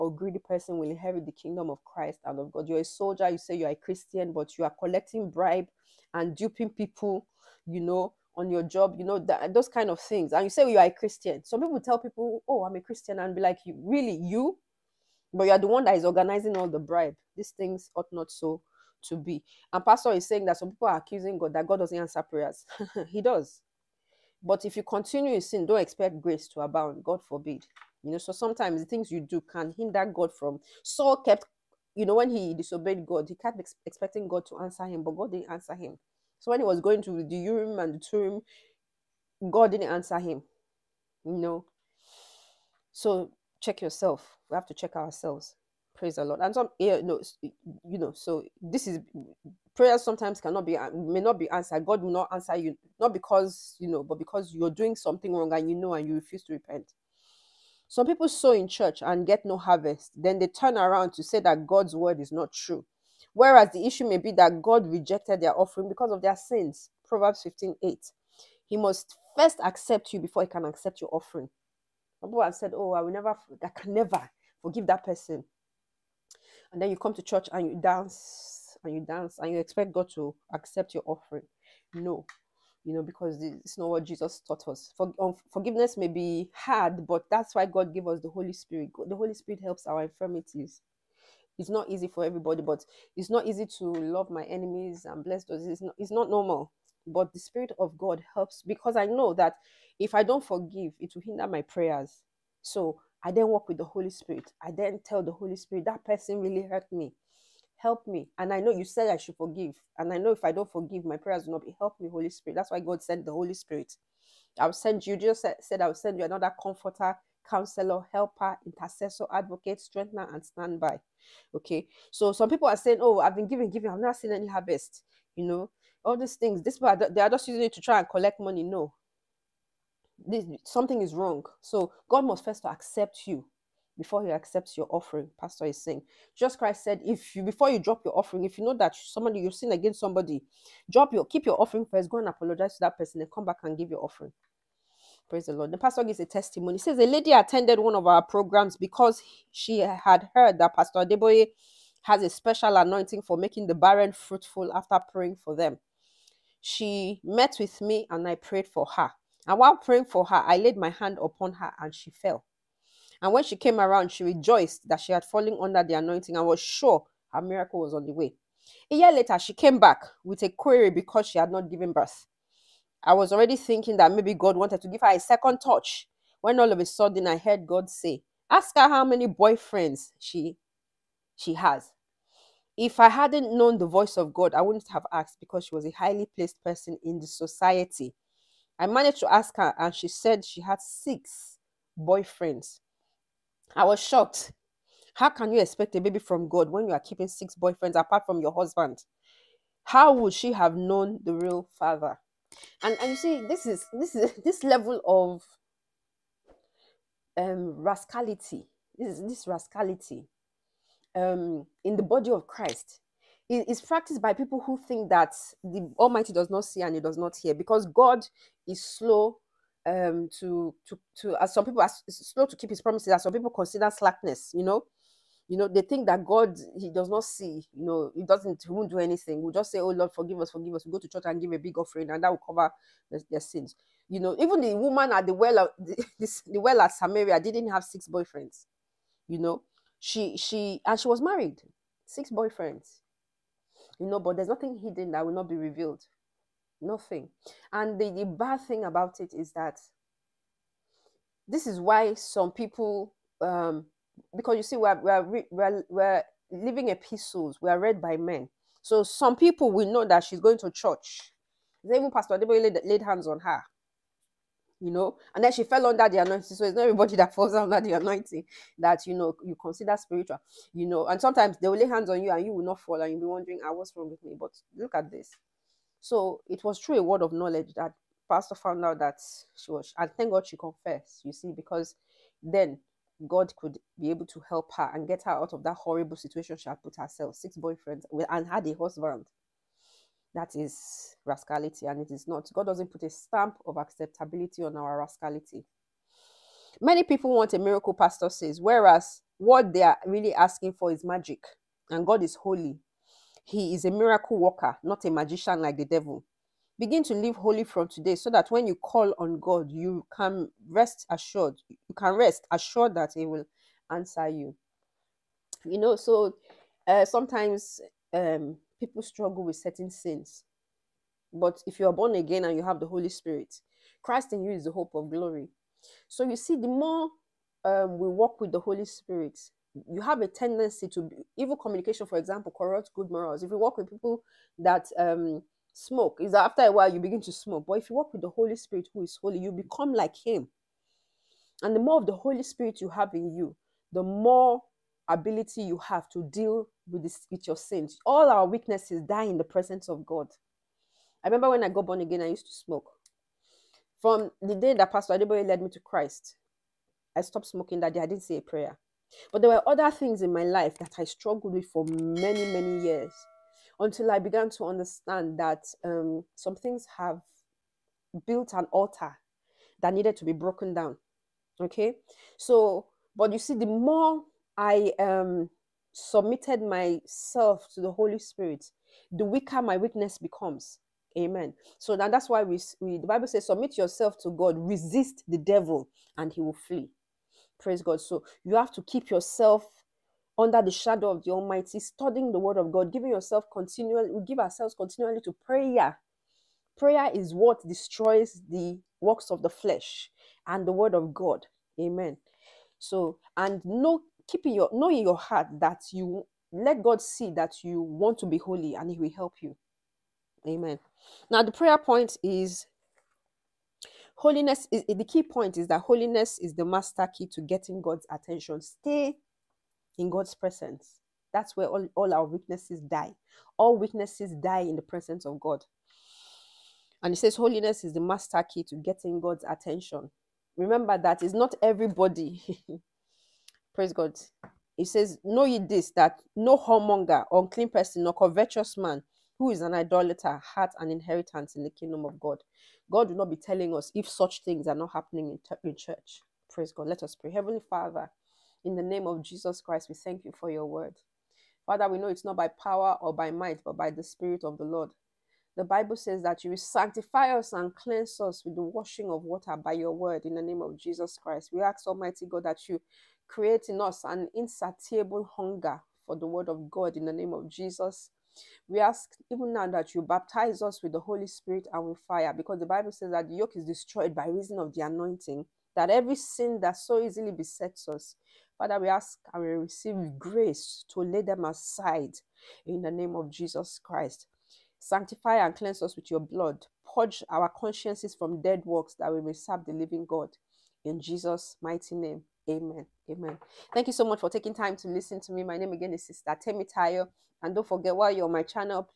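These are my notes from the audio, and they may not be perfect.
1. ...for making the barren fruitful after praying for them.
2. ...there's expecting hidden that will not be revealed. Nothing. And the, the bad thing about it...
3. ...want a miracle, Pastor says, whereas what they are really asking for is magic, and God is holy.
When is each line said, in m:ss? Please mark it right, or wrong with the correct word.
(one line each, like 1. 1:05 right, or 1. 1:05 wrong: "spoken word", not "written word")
1. 2:33 right
2. 4:04 wrong: "nothing", not "expecting"
3. 4:57 right.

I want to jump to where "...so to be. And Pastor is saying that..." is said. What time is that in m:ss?
0:18.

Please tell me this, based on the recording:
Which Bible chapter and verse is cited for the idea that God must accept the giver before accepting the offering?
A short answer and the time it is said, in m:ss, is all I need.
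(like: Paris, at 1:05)
Proverbs 15:8, at 1:07.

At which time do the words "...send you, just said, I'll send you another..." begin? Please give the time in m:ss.
1:54.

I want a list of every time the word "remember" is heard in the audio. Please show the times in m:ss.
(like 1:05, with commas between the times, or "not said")
5:51, 7:10.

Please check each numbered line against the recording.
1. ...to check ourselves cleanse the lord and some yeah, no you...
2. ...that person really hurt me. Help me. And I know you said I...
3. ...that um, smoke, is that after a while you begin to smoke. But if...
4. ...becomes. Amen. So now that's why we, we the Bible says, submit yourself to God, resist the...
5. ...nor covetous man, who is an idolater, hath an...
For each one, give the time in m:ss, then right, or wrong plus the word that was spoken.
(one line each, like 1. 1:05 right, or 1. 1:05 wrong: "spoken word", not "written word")
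1. 0:44 wrong: "praise", not "cleanse"
2. 1:45 right
3. 5:34 right
4. 6:20 right
5. 7:18 right.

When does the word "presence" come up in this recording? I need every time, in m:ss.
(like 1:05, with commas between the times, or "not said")
5:49, 7:00, 7:04.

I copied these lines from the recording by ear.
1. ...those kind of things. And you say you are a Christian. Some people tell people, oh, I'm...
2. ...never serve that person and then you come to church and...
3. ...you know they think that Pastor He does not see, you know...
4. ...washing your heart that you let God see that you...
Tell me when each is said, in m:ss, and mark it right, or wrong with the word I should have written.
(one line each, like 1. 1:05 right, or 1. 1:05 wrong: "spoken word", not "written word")
1. 0:09 right
2. 1:13 wrong: "forgive", not "serve"
3. 3:45 wrong: "God", not "Pastor"
4. 6:44 wrong: "knowing", not "washing".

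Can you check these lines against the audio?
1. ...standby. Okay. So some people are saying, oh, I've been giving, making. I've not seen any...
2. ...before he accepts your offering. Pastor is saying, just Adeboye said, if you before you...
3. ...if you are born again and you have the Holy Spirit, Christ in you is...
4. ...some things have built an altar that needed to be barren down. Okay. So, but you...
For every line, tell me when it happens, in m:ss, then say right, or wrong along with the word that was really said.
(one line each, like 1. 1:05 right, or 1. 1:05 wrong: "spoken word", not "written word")
1. 2:00 wrong: "giving", not "making"
2. 2:13 wrong: "Christ", not "Adeboye"
3. 5:21 right
4. 6:06 wrong: "broken", not "barren".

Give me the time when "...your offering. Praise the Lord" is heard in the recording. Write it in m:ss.
2:23.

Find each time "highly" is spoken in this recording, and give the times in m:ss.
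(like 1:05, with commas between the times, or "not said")
3:05.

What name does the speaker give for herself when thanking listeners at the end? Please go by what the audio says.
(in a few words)
Sister Temi Tayo.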